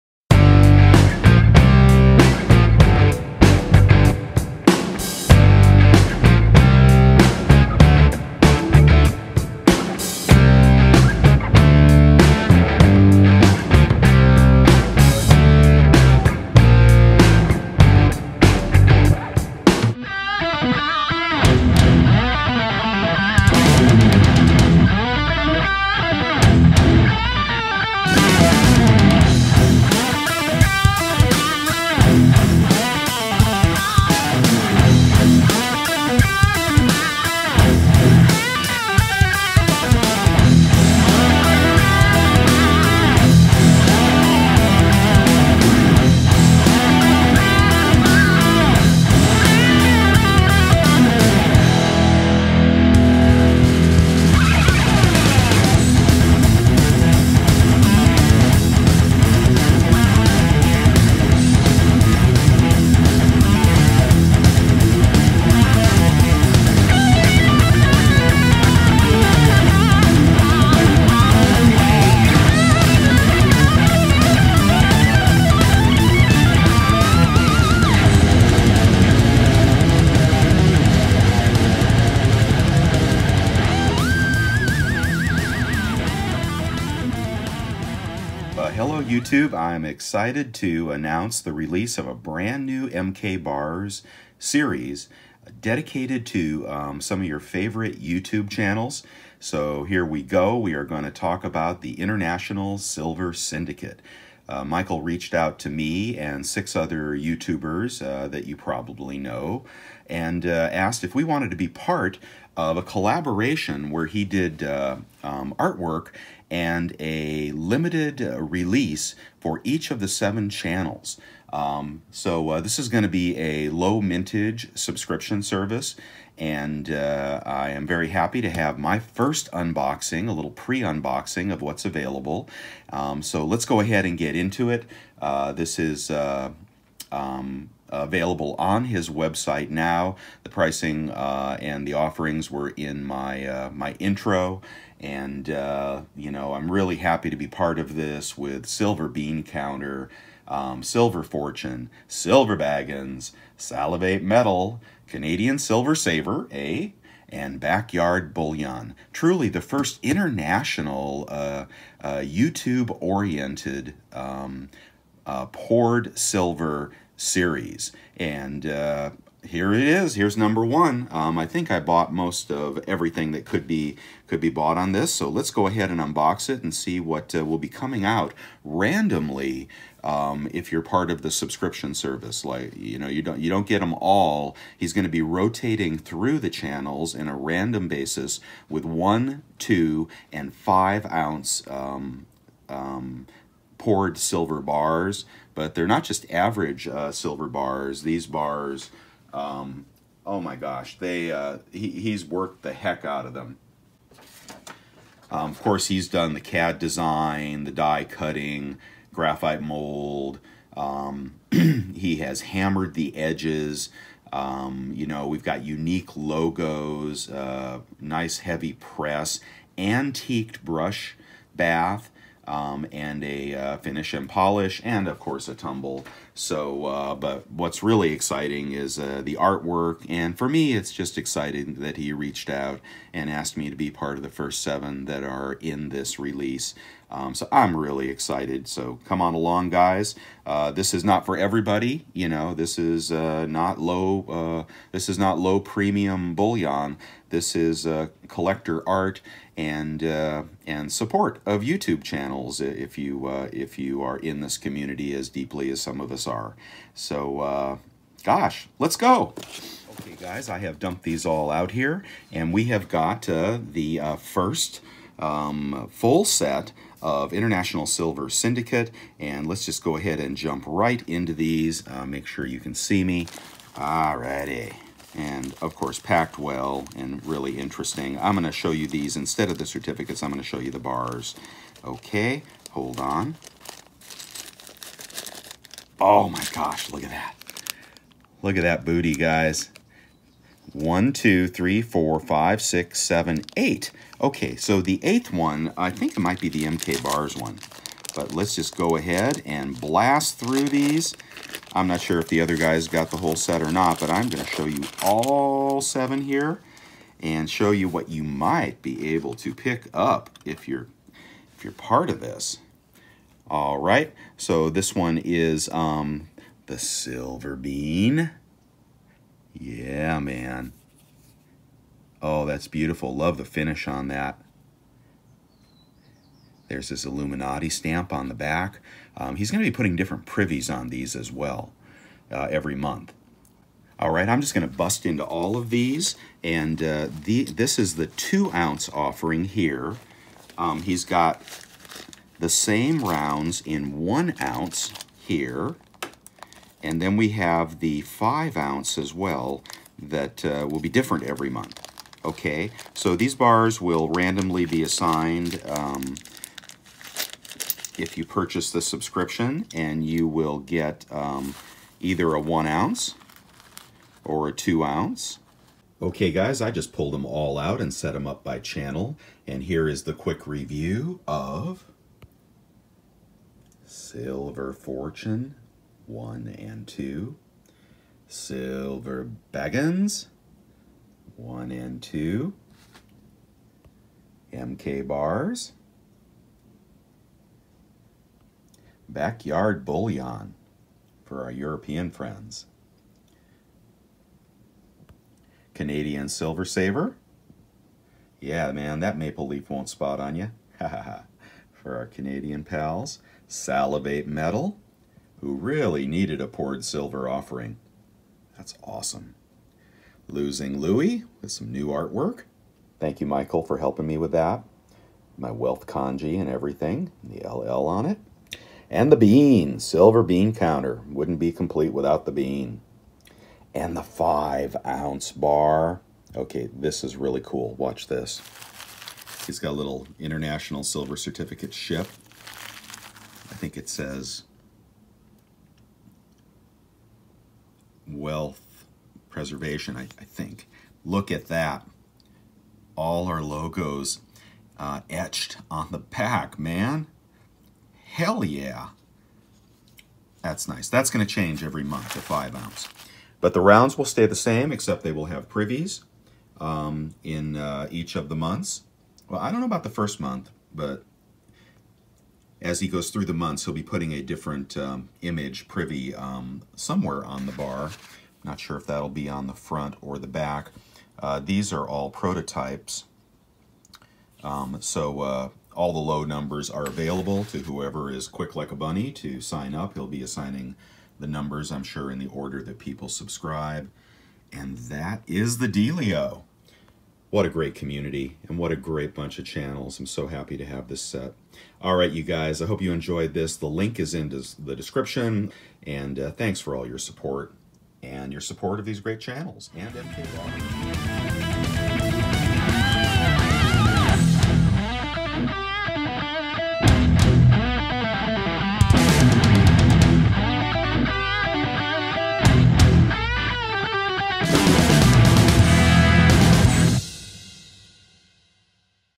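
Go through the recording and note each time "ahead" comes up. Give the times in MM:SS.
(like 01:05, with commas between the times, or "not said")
02:13, 02:55, 04:29, 04:58.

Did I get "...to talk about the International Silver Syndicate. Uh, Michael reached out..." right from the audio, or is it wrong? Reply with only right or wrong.
right.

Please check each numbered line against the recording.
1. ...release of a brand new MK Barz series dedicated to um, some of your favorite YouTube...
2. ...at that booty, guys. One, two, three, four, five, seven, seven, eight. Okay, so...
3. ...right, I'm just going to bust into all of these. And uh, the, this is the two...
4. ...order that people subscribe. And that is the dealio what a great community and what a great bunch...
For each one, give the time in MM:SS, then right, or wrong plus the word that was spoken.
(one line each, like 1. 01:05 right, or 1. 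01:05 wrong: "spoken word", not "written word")
1. 01:31 right
2. 04:48 wrong: "six", not "seven"
3. 05:34 right
4. 08:02 right.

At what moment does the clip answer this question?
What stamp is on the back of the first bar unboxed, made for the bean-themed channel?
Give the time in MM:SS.
05:27.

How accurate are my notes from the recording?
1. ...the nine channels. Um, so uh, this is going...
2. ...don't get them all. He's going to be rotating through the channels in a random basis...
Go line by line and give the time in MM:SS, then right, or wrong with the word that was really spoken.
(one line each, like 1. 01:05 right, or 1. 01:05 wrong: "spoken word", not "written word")
1. 01:59 wrong: "seven", not "nine"
2. 03:03 right.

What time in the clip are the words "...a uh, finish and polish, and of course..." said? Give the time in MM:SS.
03:43.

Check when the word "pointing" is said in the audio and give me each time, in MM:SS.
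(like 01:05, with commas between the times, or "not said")
not said.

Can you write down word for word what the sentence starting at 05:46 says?
And then we have the five ounce as well that uh, will be different every month.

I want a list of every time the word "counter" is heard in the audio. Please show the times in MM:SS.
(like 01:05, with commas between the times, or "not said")
02:29, 07:00.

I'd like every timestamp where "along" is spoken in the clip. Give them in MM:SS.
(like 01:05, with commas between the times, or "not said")
03:59.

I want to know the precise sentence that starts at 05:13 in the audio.
All right, so this one is um, the silver bean.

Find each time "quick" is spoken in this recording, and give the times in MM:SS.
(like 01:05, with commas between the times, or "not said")
06:10, 07:58.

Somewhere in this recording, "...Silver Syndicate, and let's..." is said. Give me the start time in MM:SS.
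04:27.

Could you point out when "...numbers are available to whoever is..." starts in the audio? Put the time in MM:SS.
07:56.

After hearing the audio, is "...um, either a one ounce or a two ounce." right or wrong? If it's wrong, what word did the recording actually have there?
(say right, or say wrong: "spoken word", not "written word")
right.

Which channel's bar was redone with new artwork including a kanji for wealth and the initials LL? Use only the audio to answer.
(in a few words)
Losing Louie.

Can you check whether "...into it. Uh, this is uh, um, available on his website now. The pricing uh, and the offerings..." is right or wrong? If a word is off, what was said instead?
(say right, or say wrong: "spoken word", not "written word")
right.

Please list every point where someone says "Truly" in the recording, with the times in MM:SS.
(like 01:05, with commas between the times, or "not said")
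02:39.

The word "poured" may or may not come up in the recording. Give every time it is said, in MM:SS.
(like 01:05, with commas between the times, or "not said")
02:45, 03:13, 06:46.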